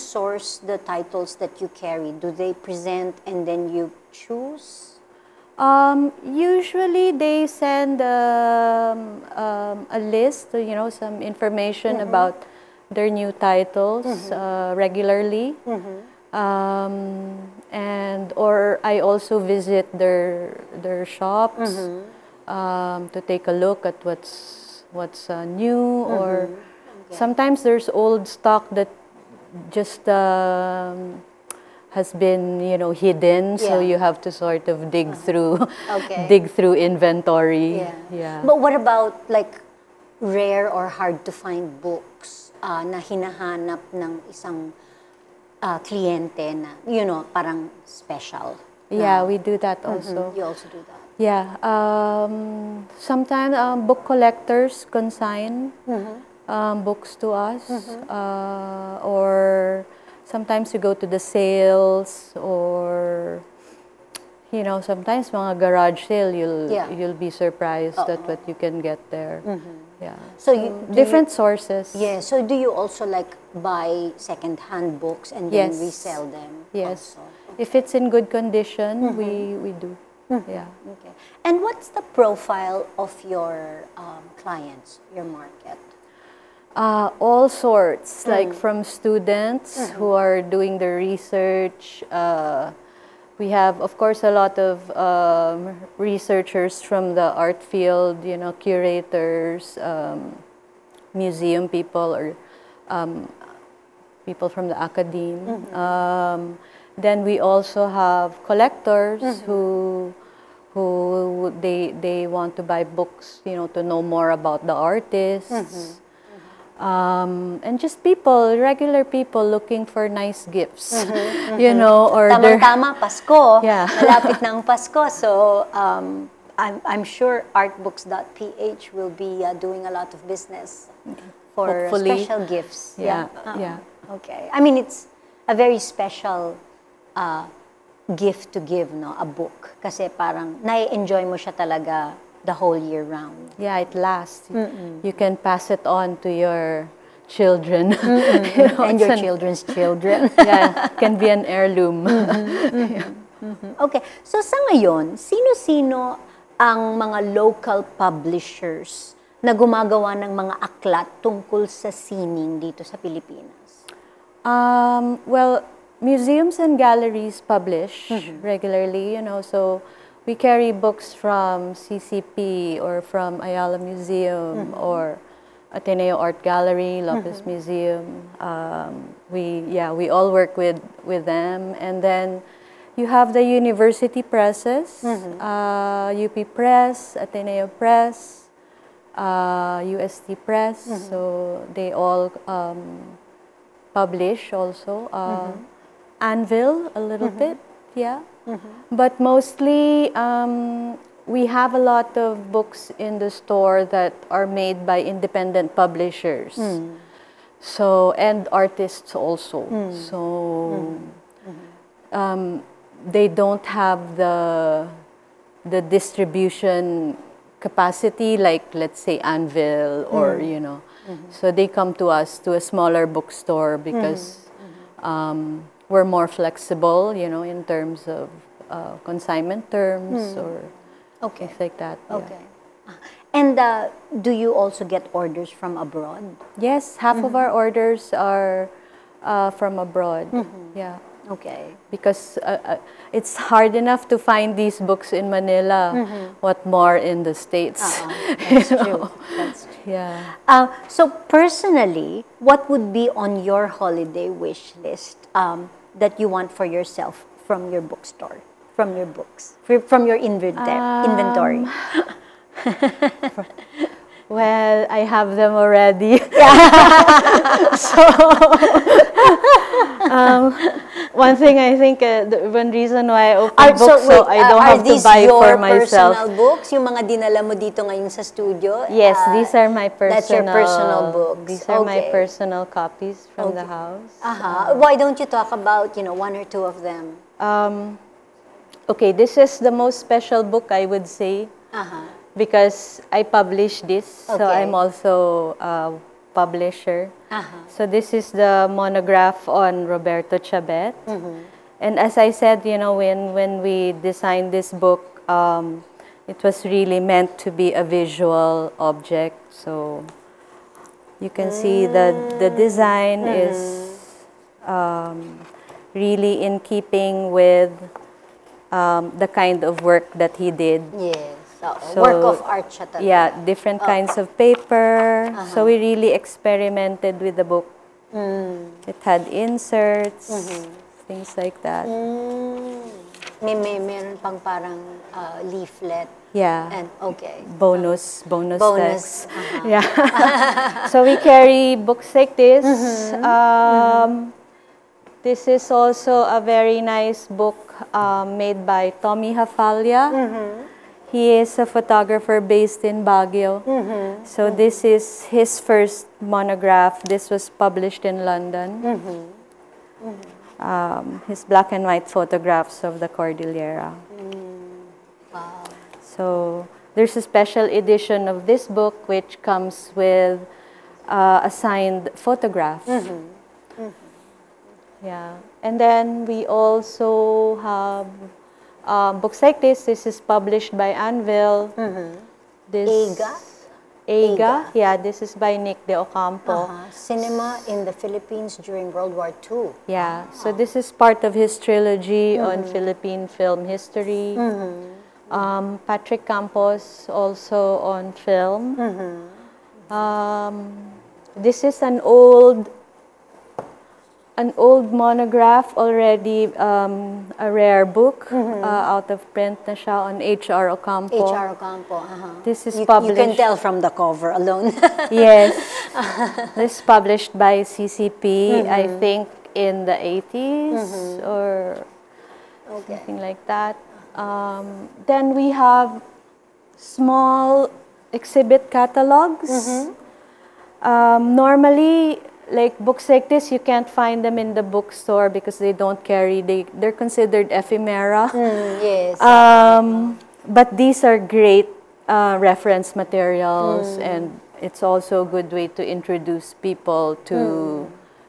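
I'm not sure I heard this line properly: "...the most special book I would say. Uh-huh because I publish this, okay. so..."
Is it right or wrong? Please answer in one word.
right.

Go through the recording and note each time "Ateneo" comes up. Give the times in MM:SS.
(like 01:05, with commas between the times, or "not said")
02:55, 03:07.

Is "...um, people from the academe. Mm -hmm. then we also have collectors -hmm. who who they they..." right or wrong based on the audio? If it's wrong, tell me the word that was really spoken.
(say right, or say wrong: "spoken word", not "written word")
right.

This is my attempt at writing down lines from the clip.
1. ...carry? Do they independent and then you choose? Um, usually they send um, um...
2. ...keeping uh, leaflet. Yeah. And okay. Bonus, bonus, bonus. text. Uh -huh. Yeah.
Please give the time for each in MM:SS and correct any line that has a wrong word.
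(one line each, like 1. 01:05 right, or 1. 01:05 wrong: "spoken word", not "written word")
1. 00:01 wrong: "present", not "independent"
2. 05:34 wrong: "parang", not "keeping".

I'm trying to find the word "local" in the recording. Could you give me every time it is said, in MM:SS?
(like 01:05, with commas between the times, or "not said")
02:37.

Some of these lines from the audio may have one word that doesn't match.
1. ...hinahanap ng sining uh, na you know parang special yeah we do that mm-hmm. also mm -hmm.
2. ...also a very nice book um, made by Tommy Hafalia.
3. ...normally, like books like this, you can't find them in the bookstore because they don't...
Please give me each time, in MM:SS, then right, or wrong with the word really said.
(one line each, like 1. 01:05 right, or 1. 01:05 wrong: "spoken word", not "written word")
1. 00:42 wrong: "isang", not "sining"
2. 05:45 right
3. 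07:11 right.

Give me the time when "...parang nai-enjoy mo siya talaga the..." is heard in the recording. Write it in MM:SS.
02:20.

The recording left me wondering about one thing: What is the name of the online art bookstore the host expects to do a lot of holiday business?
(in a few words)
artbooks.ph.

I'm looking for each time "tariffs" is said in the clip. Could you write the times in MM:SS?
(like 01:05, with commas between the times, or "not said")
not said.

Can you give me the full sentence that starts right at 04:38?
Yes, uh, these are my personal.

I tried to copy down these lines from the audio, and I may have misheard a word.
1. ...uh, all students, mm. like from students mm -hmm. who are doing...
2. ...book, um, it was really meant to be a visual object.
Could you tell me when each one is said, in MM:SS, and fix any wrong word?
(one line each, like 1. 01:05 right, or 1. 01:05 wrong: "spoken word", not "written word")
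1. 01:26 wrong: "sorts", not "students"
2. 05:04 right.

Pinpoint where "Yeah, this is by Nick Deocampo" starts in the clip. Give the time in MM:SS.
06:24.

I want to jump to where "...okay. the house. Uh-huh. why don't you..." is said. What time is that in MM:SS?
04:43.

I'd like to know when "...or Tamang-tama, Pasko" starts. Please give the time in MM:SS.
02:02.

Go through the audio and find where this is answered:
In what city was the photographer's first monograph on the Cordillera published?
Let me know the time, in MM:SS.
05:58.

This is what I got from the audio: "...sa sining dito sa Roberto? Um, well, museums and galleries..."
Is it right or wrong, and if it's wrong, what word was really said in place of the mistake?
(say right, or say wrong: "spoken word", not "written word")
wrong: "Pilipinas", not "Roberto".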